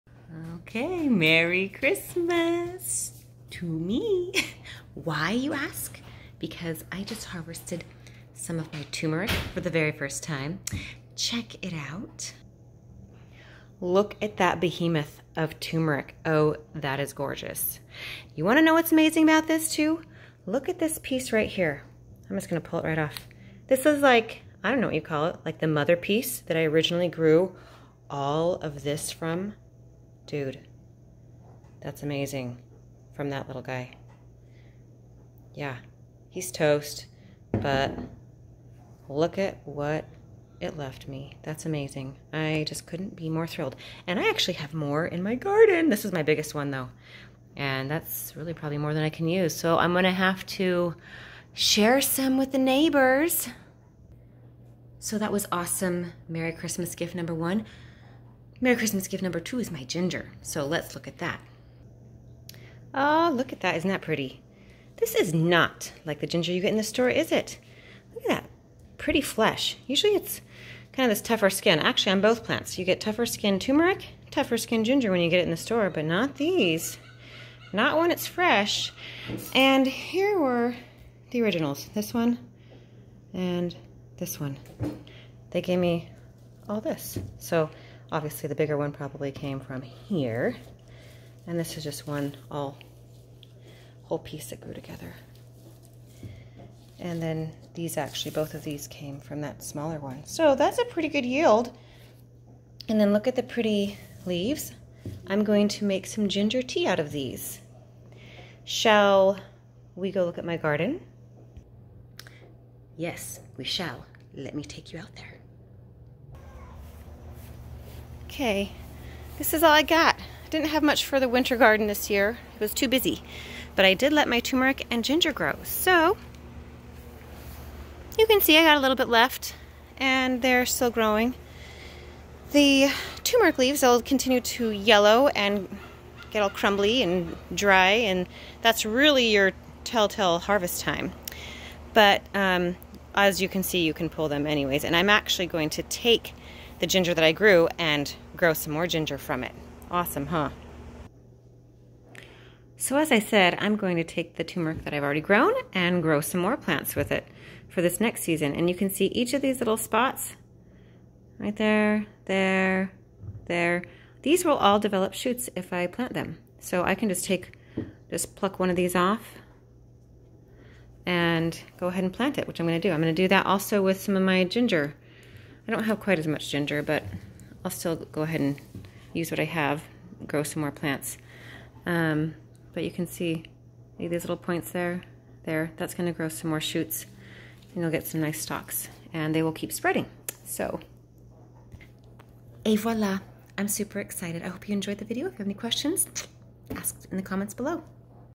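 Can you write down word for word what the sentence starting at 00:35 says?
Yeah, he's toast, but look at what it left me.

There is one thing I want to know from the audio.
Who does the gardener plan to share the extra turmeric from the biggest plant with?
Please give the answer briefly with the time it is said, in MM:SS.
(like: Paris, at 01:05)
the neighbors, at 00:52.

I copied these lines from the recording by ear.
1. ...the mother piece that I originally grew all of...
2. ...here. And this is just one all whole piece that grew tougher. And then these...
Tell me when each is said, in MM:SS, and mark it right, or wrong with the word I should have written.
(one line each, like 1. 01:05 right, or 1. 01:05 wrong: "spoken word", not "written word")
1. 00:25 right
2. 01:29 wrong: "together", not "tougher".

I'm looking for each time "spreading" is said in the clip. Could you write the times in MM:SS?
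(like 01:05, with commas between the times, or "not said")
03:09.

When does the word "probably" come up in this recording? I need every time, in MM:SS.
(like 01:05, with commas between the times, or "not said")
00:48, 01:28.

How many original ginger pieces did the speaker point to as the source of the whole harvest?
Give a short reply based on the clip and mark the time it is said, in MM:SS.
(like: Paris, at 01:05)
2, at 01:21.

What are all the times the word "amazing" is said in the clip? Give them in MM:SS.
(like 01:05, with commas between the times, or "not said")
00:18, 00:32, 00:41.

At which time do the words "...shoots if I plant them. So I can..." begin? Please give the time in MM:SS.
02:45.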